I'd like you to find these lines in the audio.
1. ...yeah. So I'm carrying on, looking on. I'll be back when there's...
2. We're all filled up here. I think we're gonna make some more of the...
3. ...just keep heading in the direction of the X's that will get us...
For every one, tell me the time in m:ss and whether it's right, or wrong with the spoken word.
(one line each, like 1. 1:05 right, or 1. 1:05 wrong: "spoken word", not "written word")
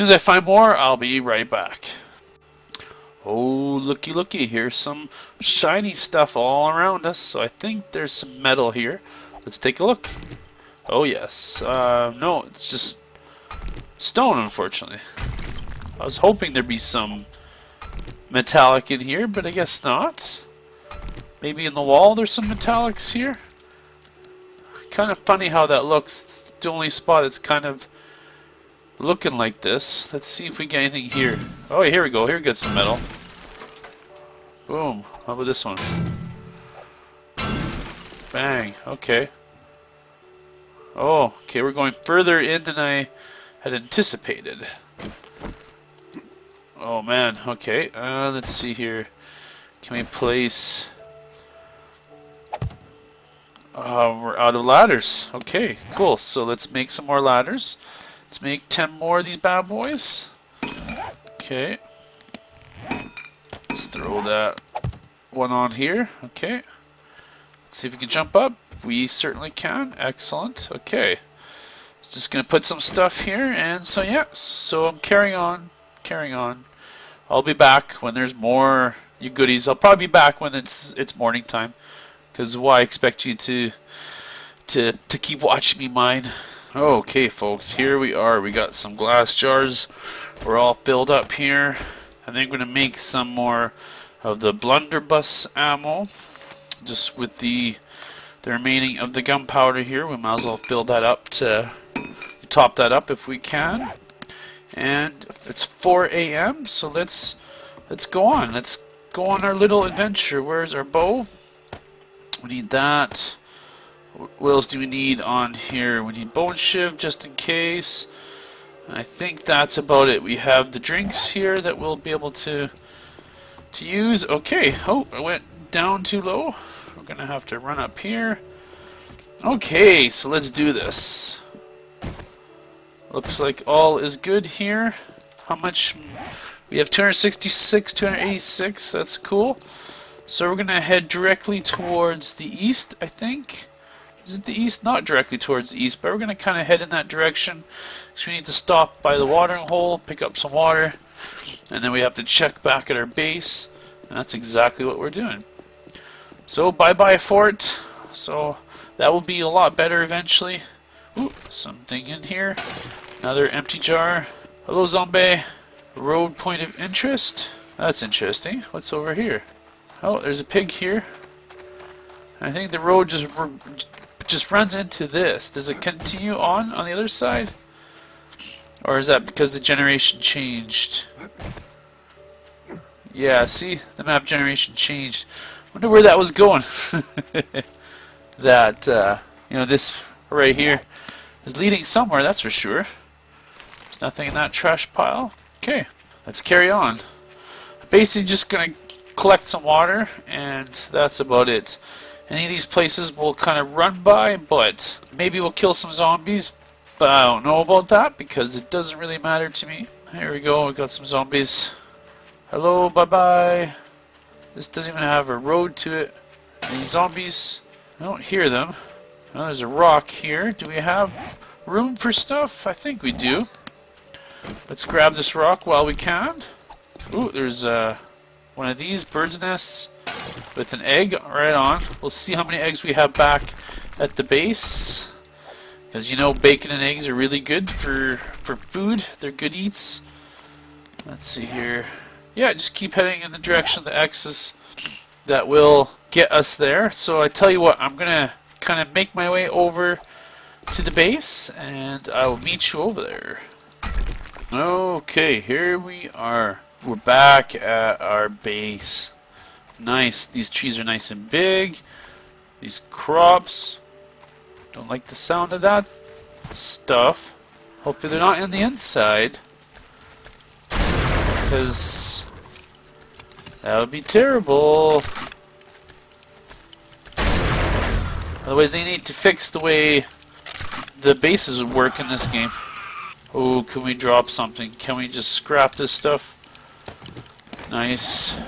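1. 1:14 wrong: "carrying", not "looking"
2. 1:30 right
3. 4:02 right.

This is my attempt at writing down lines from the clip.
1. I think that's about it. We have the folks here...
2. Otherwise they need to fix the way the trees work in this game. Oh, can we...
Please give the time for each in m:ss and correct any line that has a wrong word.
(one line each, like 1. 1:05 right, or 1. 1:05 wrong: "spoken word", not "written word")
1. 1:58 wrong: "drinks", not "folks"
2. 4:38 wrong: "bases", not "trees".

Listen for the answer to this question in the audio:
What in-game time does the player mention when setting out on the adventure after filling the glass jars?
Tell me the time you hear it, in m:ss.
1:45.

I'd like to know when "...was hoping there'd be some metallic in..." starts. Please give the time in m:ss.
0:16.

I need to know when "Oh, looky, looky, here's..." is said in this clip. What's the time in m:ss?
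0:03.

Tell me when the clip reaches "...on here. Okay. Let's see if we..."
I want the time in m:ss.
1:05.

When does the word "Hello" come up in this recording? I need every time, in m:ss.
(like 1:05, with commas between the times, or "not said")
2:44, 3:32.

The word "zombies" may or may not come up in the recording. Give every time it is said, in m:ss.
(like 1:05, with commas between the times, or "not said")
2:44, 3:25, 3:31, 3:36.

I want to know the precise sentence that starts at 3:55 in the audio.
Because you know bacon and eggs are really good for, for food.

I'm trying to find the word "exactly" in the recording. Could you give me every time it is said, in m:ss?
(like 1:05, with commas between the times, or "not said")
2:34.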